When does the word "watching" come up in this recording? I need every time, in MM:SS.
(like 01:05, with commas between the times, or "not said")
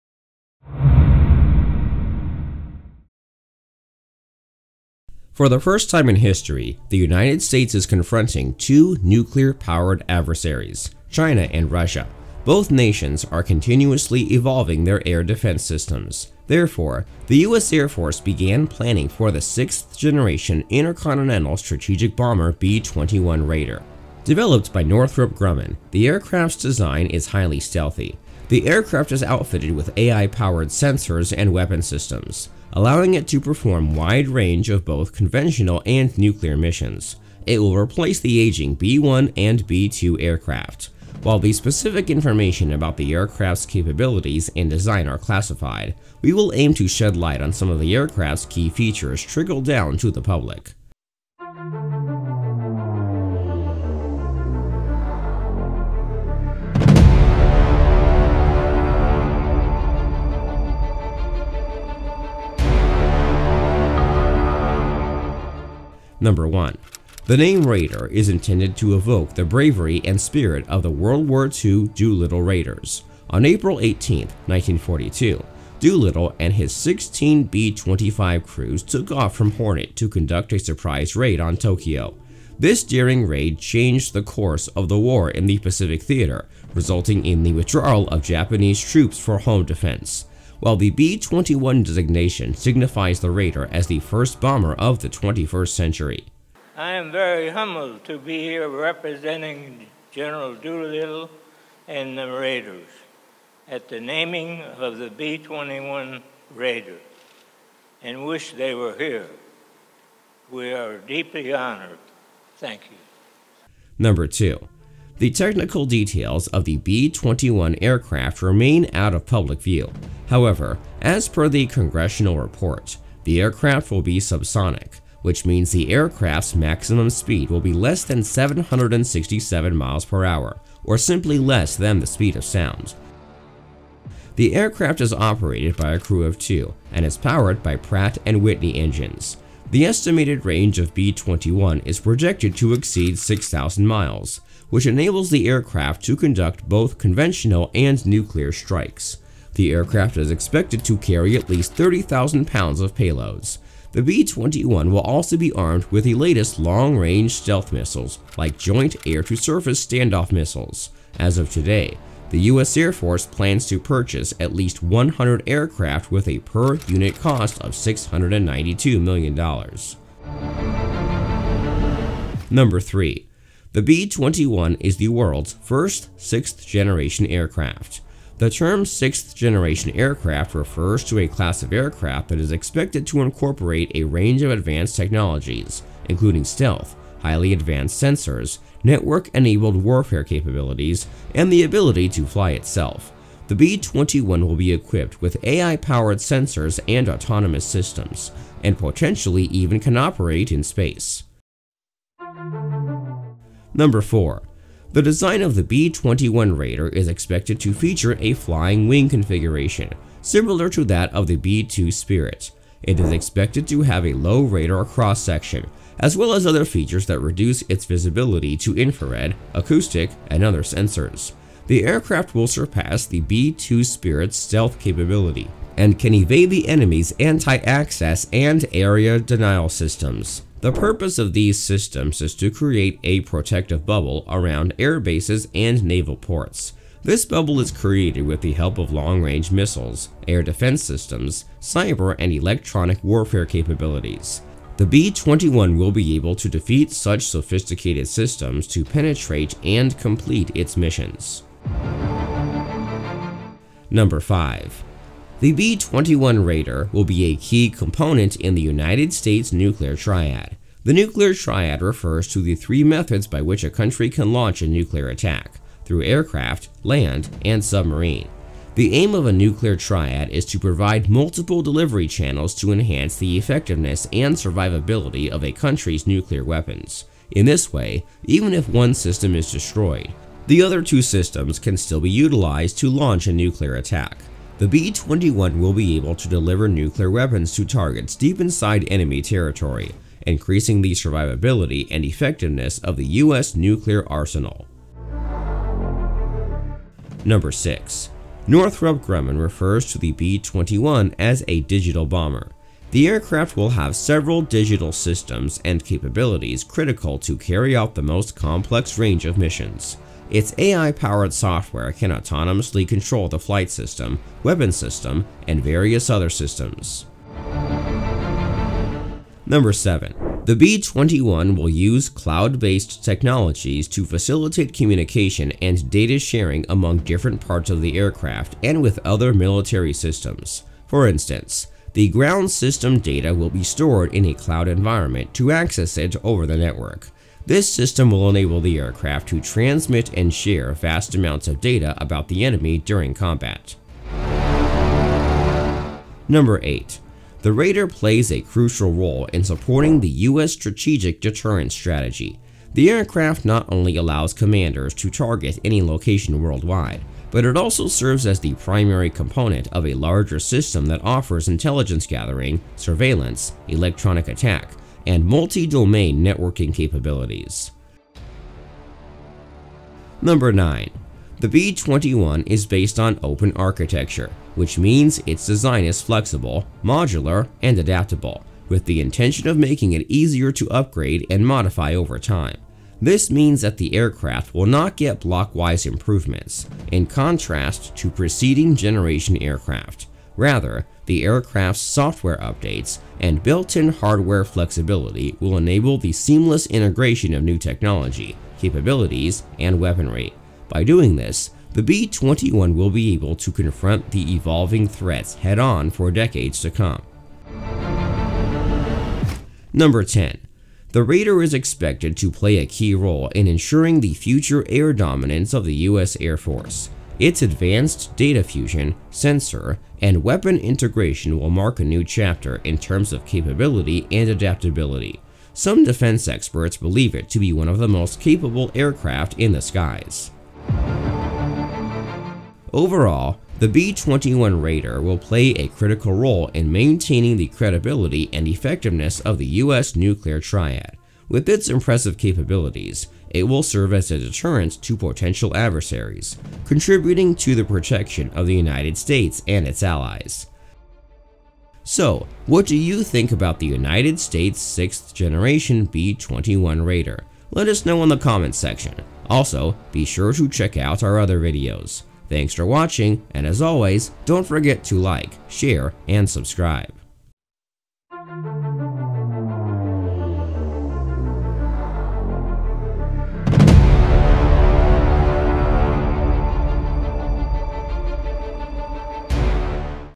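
07:42.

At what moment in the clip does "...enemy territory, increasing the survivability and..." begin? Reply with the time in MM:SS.
04:48.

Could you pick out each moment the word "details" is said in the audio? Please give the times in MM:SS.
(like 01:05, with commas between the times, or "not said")
01:55.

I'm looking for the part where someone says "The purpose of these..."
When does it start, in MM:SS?
03:50.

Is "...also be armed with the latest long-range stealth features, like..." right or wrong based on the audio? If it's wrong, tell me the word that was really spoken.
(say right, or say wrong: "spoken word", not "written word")
wrong: "missiles", not "features".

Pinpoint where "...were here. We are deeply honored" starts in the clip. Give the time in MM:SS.
01:48.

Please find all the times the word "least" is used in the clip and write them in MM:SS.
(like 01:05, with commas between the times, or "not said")
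02:31, 02:44.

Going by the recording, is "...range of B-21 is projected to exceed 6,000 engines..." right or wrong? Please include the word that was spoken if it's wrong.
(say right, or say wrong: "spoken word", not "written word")
wrong: "miles", not "engines".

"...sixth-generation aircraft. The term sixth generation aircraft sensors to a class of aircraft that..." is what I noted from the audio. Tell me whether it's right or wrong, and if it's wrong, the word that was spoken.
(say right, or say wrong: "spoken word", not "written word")
wrong: "refers", not "sensors".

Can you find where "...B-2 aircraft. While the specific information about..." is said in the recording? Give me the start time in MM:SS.
00:39.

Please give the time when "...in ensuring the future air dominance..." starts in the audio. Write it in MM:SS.
06:53.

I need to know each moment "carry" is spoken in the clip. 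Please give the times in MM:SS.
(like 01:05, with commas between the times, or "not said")
02:30, 05:07.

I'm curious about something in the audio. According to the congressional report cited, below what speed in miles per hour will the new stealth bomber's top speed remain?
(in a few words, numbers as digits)
767 miles per hour.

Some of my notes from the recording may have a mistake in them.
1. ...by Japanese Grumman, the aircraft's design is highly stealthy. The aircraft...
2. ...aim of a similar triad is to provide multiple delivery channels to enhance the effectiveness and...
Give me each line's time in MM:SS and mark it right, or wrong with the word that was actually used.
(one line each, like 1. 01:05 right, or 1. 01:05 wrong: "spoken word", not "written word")
1. 00:24 wrong: "Northrop", not "Japanese"
2. 04:28 wrong: "nuclear", not "similar".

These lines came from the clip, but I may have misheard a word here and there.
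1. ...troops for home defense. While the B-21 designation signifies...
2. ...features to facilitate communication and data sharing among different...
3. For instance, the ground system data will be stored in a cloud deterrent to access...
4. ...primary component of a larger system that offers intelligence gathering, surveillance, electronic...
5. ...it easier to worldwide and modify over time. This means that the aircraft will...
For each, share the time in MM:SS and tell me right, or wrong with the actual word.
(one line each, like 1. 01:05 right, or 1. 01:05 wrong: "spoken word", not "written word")
1. 01:28 right
2. 05:23 wrong: "technologies", not "features"
3. 05:30 wrong: "environment", not "deterrent"
4. 05:58 right
5. 06:19 wrong: "upgrade", not "worldwide".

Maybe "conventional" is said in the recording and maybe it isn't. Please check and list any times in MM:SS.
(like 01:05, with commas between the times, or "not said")
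00:35, 02:26.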